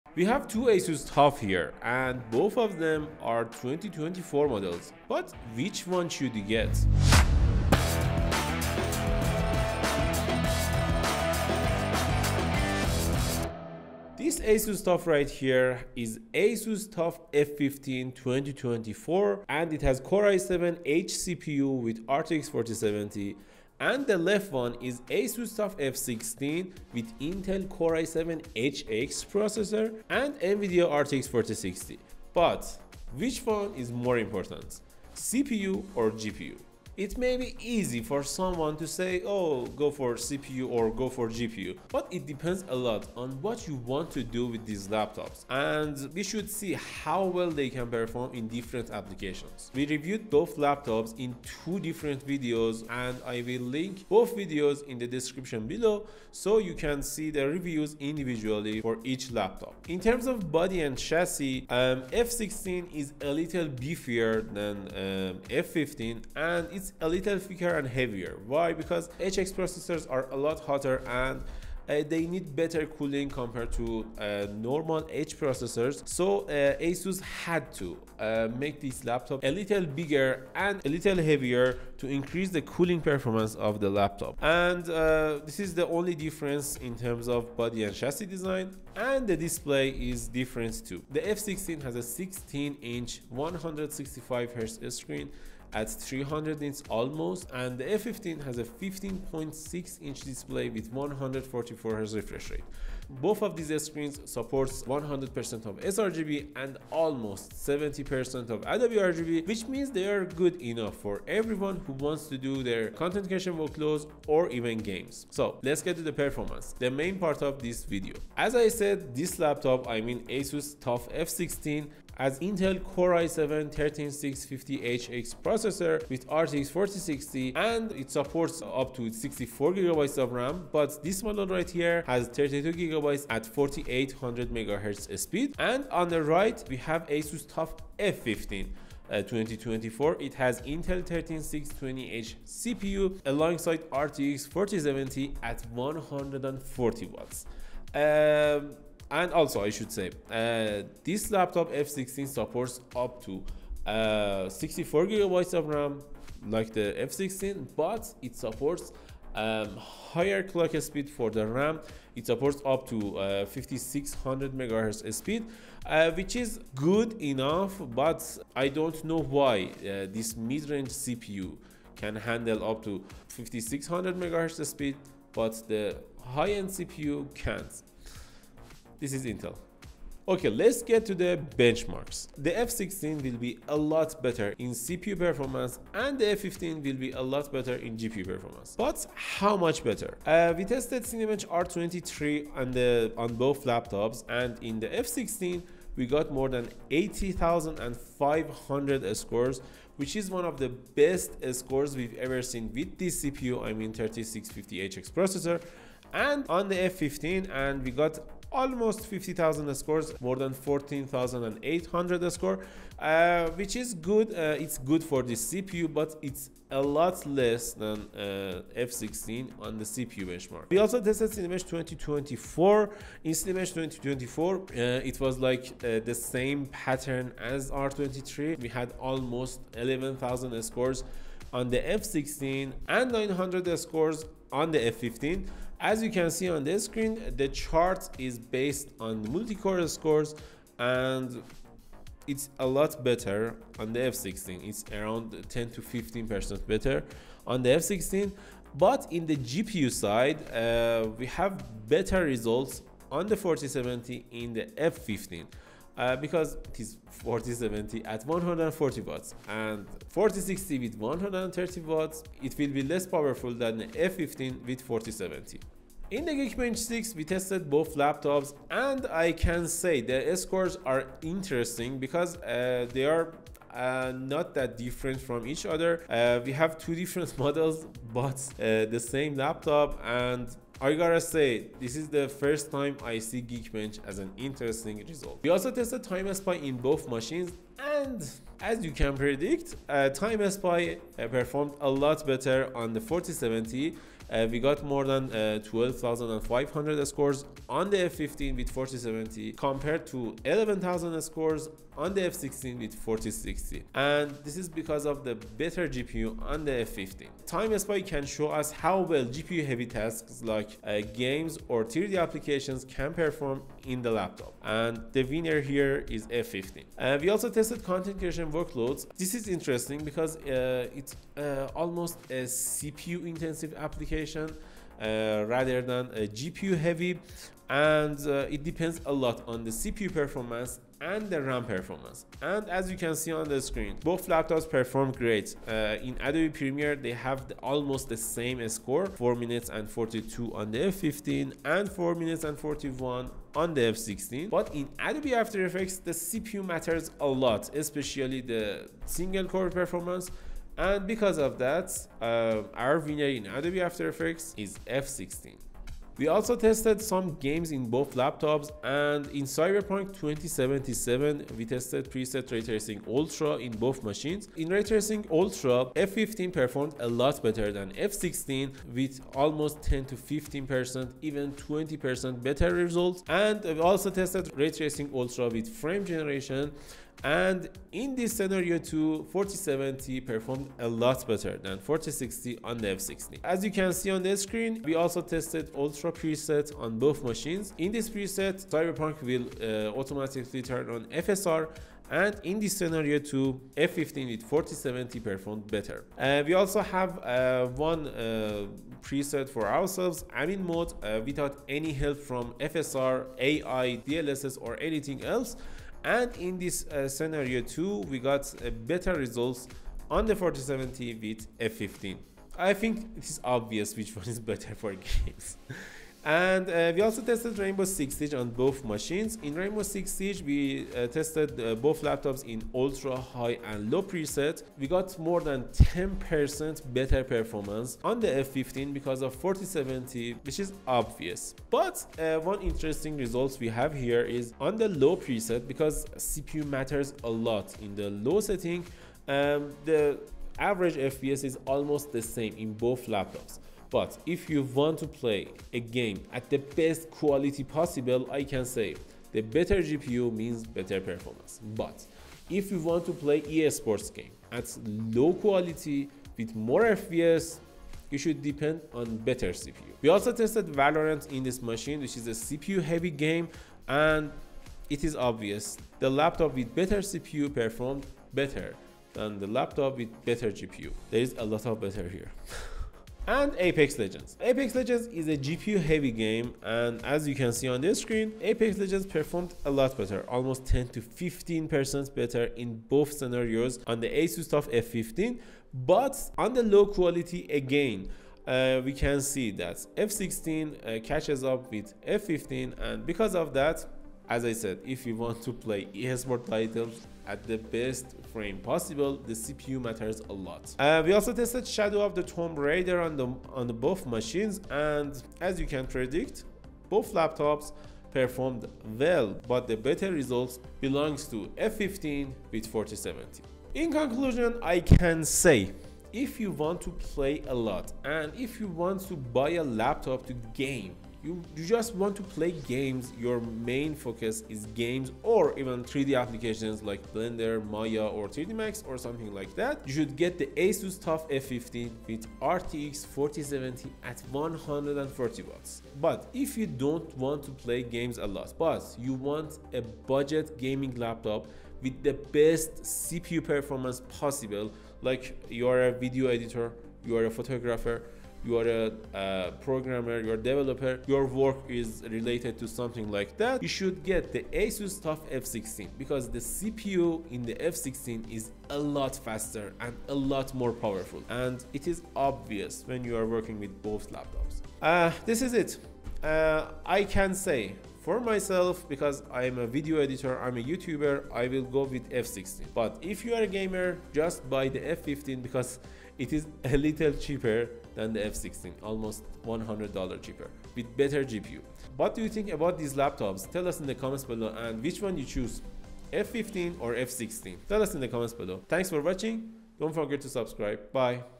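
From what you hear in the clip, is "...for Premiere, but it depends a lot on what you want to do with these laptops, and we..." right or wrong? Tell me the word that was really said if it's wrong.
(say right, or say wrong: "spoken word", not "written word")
wrong: "GPU", not "Premiere".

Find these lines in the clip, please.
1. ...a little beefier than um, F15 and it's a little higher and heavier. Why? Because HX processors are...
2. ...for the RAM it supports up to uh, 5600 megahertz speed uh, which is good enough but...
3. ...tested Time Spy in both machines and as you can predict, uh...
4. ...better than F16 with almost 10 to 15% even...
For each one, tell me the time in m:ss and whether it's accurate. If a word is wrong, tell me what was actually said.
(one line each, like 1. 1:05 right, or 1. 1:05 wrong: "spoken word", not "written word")
1. 1:03 wrong: "thicker", not "higher"
2. 2:41 right
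3. 4:45 right
4. 6:07 right.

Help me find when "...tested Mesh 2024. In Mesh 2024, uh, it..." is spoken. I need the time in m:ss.
3:41.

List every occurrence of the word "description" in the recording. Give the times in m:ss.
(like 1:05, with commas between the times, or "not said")
0:55.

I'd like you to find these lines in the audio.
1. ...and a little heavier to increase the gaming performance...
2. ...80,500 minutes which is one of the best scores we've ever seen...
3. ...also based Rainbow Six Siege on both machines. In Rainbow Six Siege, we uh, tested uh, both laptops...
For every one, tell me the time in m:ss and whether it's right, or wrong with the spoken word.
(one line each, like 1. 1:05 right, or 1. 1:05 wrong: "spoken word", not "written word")
1. 1:20 wrong: "cooling", not "gaming"
2. 3:16 wrong: "scores", not "minutes"
3. 6:57 wrong: "tested", not "based".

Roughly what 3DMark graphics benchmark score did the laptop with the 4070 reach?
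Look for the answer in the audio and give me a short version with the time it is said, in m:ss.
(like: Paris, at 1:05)
12,500, at 4:55.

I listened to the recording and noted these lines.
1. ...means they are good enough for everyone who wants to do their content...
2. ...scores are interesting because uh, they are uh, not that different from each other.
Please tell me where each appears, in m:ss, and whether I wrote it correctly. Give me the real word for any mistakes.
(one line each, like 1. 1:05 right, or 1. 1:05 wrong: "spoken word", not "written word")
1. 1:49 right
2. 4:30 right.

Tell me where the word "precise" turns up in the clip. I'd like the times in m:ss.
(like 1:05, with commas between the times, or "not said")
not said.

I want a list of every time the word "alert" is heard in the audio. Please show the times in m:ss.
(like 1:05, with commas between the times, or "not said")
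not said.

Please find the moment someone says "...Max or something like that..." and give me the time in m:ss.
8:48.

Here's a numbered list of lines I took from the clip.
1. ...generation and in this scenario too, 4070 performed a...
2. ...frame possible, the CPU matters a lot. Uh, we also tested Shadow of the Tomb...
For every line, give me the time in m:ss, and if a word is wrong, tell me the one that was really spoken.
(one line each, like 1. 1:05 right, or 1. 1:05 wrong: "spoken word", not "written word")
1. 6:16 right
2. 8:18 right.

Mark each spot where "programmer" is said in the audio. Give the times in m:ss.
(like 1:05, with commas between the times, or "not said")
9:09.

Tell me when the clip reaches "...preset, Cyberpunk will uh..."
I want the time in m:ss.
6:28.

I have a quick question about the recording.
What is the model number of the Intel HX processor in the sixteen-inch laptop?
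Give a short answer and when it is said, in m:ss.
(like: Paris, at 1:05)
13650HX, at 2:03.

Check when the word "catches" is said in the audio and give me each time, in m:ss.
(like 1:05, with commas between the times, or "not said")
8:11.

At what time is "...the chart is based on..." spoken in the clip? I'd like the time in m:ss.
3:57.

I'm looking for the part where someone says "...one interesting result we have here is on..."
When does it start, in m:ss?
7:12.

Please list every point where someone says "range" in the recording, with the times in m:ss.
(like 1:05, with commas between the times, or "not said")
2:50.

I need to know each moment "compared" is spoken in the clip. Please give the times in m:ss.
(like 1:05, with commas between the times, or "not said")
1:13, 4:59.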